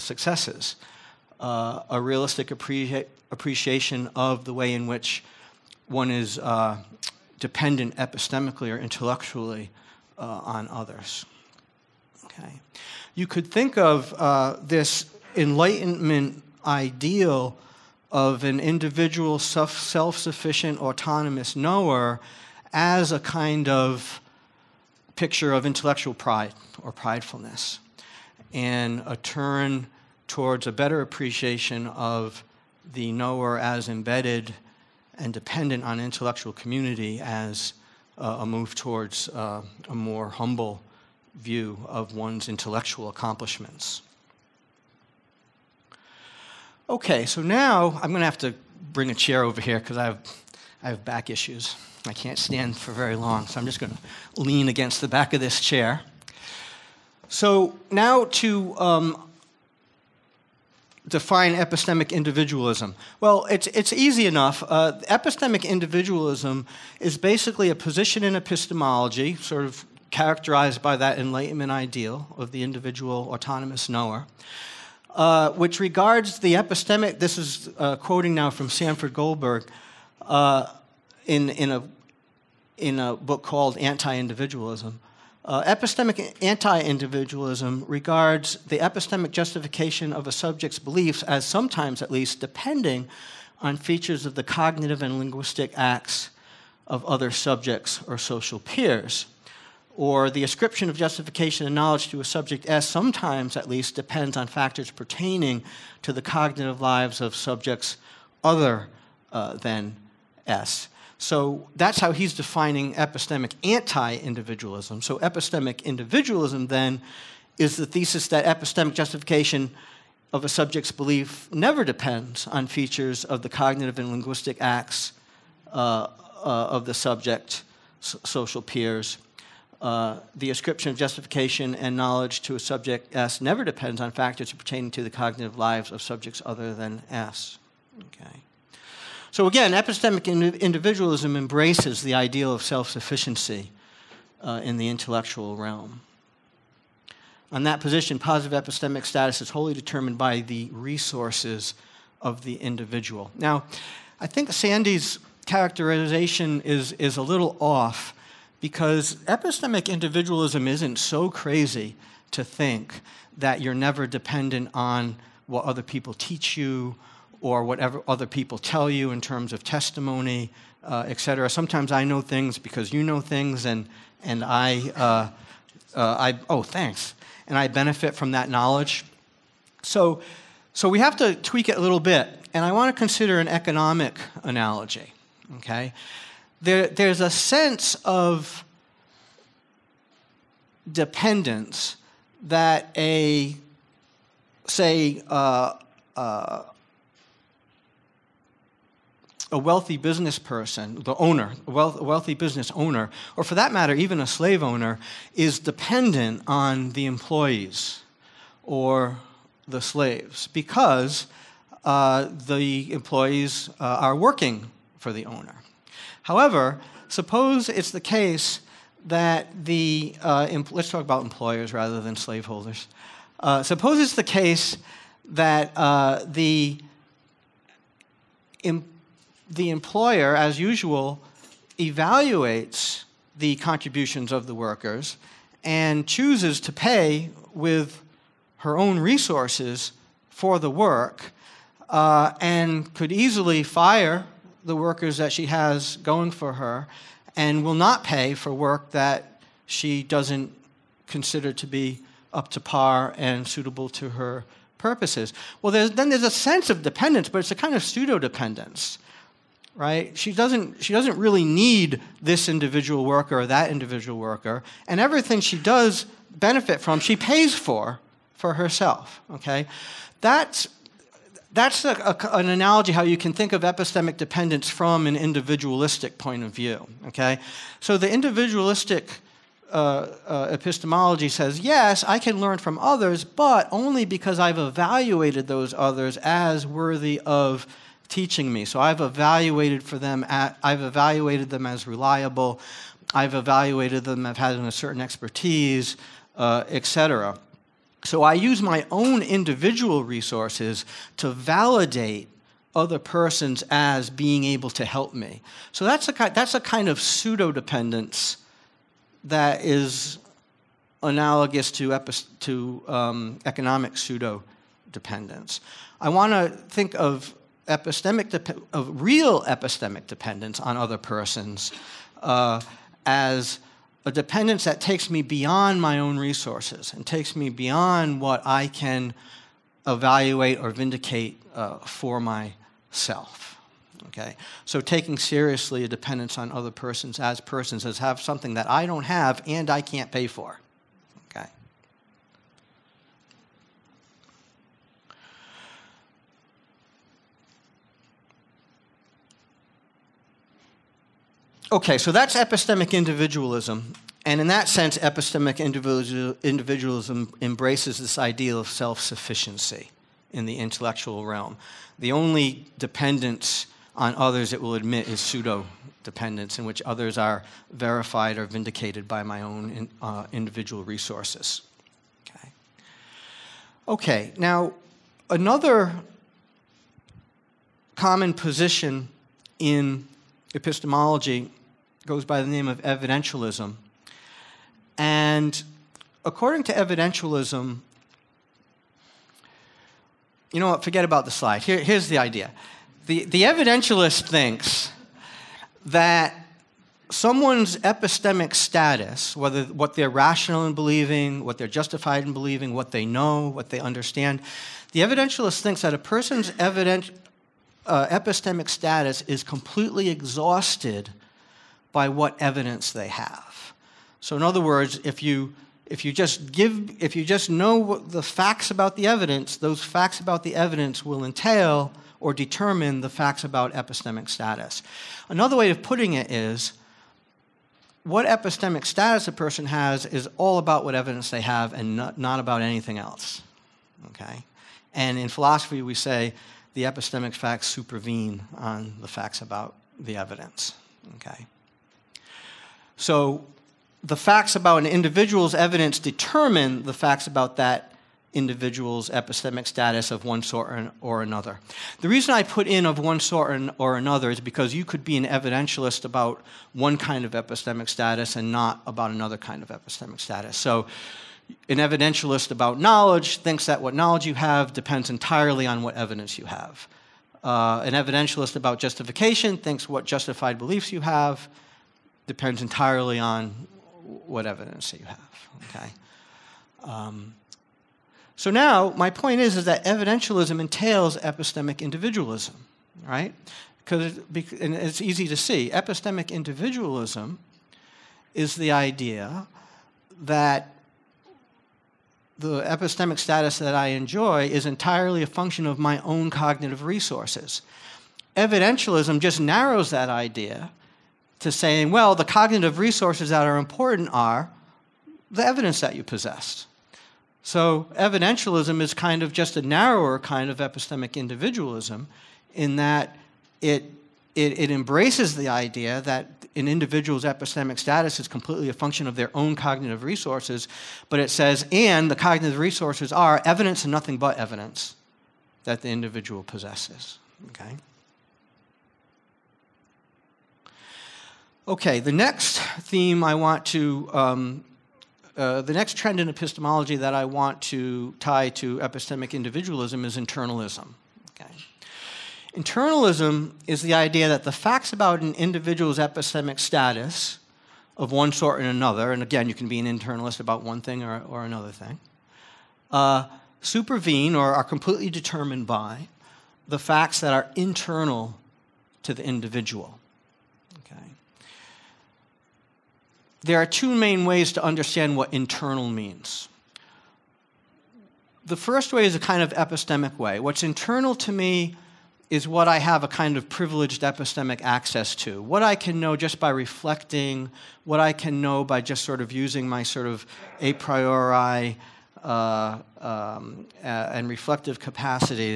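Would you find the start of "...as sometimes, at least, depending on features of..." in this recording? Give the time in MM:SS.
01:31.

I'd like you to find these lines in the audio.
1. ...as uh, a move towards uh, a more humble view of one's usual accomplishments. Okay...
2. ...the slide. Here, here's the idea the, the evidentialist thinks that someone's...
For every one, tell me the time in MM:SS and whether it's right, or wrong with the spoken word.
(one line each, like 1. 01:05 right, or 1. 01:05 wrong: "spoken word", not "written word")
1. 00:37 wrong: "intellectual", not "usual"
2. 06:31 right.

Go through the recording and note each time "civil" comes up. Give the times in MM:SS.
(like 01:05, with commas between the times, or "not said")
not said.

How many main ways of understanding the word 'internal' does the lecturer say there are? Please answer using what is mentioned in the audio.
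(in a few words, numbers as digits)
2.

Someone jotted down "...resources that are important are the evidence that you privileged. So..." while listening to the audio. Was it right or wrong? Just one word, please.
wrong.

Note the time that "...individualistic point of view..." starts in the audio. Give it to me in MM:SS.
04:35.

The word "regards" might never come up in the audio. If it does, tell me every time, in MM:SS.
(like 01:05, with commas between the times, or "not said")
01:15, 01:27.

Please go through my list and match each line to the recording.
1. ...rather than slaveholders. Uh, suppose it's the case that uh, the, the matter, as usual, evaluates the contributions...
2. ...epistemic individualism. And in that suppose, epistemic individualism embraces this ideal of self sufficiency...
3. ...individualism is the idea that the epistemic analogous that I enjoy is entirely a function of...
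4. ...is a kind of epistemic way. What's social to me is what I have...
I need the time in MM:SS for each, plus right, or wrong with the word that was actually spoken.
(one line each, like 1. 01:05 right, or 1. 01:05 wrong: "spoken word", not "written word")
1. 03:41 wrong: "employer", not "matter"
2. 05:52 wrong: "sense", not "suppose"
3. 08:06 wrong: "status", not "analogous"
4. 09:29 wrong: "internal", not "social".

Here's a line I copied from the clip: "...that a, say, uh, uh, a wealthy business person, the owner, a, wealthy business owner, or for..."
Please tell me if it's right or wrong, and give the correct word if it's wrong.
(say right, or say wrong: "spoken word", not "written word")
right.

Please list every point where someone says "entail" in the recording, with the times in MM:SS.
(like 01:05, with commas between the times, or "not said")
07:01, 08:00.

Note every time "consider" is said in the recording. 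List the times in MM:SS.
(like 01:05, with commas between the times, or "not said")
03:02, 04:11.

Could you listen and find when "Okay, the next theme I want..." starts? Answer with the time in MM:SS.
08:51.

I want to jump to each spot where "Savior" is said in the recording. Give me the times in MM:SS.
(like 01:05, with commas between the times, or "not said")
not said.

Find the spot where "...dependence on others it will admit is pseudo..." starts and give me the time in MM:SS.
06:02.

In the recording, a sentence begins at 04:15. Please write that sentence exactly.
Well, there's, then there's a sense of dependence, but it's a kind of pseudo dependence right?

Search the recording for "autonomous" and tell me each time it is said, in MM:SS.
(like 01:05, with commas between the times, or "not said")
00:20, 01:13.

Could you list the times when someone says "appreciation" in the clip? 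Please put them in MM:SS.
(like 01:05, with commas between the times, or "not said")
00:02, 00:31.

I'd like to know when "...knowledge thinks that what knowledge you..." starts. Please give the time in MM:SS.
07:42.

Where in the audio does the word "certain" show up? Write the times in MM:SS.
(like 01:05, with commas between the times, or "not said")
04:54.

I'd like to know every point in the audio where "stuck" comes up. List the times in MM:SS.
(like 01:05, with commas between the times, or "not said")
not said.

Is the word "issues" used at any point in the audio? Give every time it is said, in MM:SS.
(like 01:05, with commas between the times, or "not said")
00:51.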